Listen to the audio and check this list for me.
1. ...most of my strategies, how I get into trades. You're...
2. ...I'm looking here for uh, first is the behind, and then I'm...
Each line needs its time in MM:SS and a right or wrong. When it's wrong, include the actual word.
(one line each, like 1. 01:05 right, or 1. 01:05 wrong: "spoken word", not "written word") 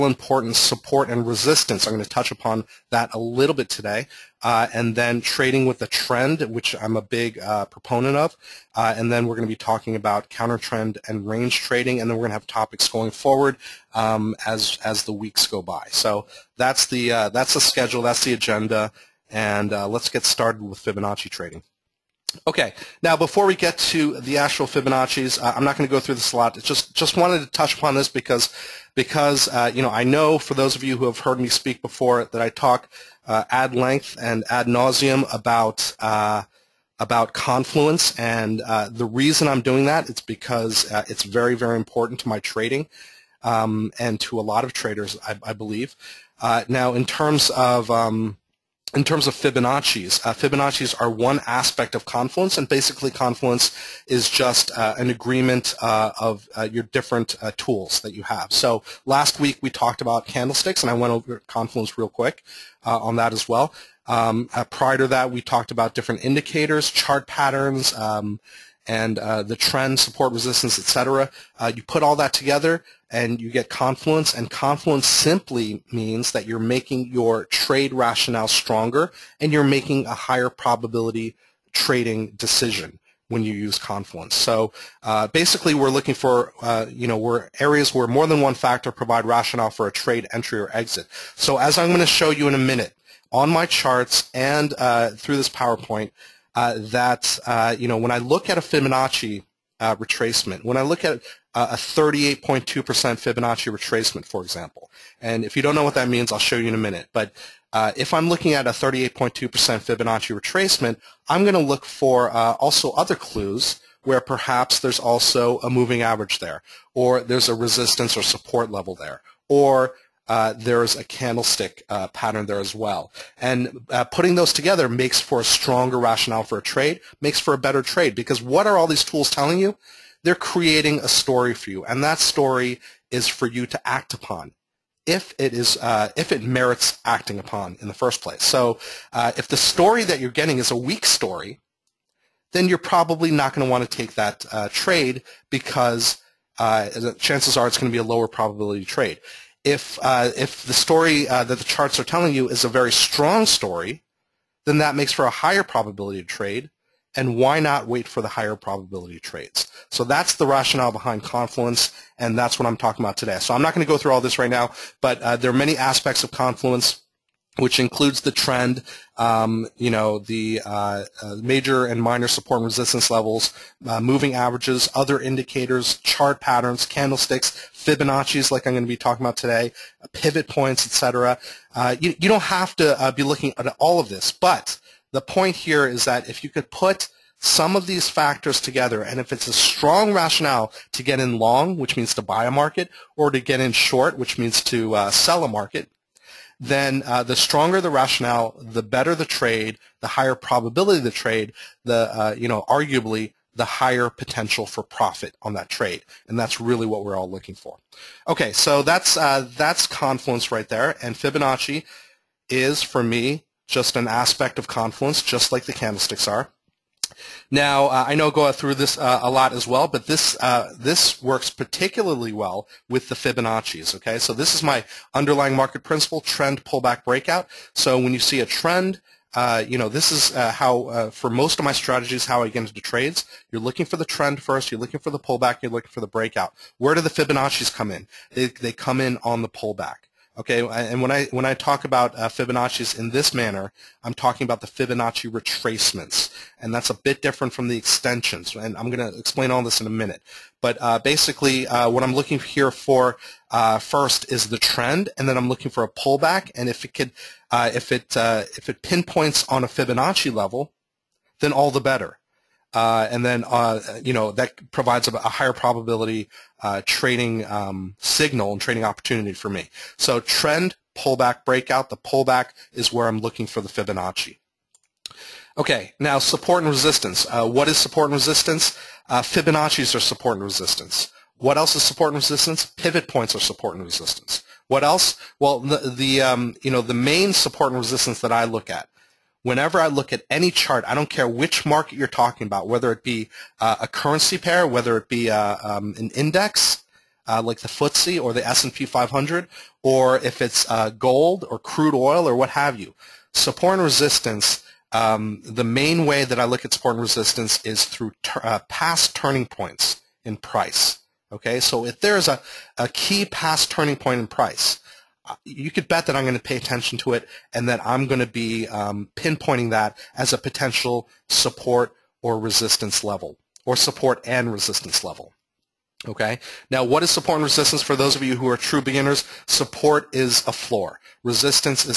1. 03:51 right
2. 04:12 wrong: "trend", not "behind".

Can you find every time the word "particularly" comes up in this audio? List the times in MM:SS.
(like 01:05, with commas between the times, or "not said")
03:41.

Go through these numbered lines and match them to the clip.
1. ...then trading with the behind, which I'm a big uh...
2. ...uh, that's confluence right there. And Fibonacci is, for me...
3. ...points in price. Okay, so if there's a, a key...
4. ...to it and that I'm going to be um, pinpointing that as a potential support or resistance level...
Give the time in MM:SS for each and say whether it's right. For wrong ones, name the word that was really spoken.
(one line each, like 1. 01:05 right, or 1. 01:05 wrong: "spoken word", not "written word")
1. 00:04 wrong: "trend", not "behind"
2. 03:29 right
3. 05:09 right
4. 05:16 right.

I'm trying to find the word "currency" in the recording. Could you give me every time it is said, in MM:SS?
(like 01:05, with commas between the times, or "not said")
04:53.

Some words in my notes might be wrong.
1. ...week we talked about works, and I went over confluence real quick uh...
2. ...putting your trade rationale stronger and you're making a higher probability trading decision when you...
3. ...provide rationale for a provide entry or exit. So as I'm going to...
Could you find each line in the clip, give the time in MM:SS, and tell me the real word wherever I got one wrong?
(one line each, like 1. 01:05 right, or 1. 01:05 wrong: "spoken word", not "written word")
1. 00:59 wrong: "candlesticks", not "works"
2. 01:16 wrong: "making", not "putting"
3. 01:28 wrong: "trade", not "provide".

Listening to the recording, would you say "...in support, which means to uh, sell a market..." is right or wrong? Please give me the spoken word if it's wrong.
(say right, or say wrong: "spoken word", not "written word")
wrong: "short", not "support".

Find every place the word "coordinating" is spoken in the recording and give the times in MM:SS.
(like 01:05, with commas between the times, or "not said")
not said.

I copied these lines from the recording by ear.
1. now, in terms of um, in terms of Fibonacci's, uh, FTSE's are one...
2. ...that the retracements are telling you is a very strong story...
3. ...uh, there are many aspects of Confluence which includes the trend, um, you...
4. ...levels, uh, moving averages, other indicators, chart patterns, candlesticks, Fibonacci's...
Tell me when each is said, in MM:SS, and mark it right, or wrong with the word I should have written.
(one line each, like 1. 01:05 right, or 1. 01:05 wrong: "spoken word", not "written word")
1. 00:46 wrong: "Fibonacci", not "FTSE"
2. 02:31 wrong: "charts", not "retracements"
3. 02:45 right
4. 02:53 right.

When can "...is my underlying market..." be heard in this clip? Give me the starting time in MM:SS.
03:44.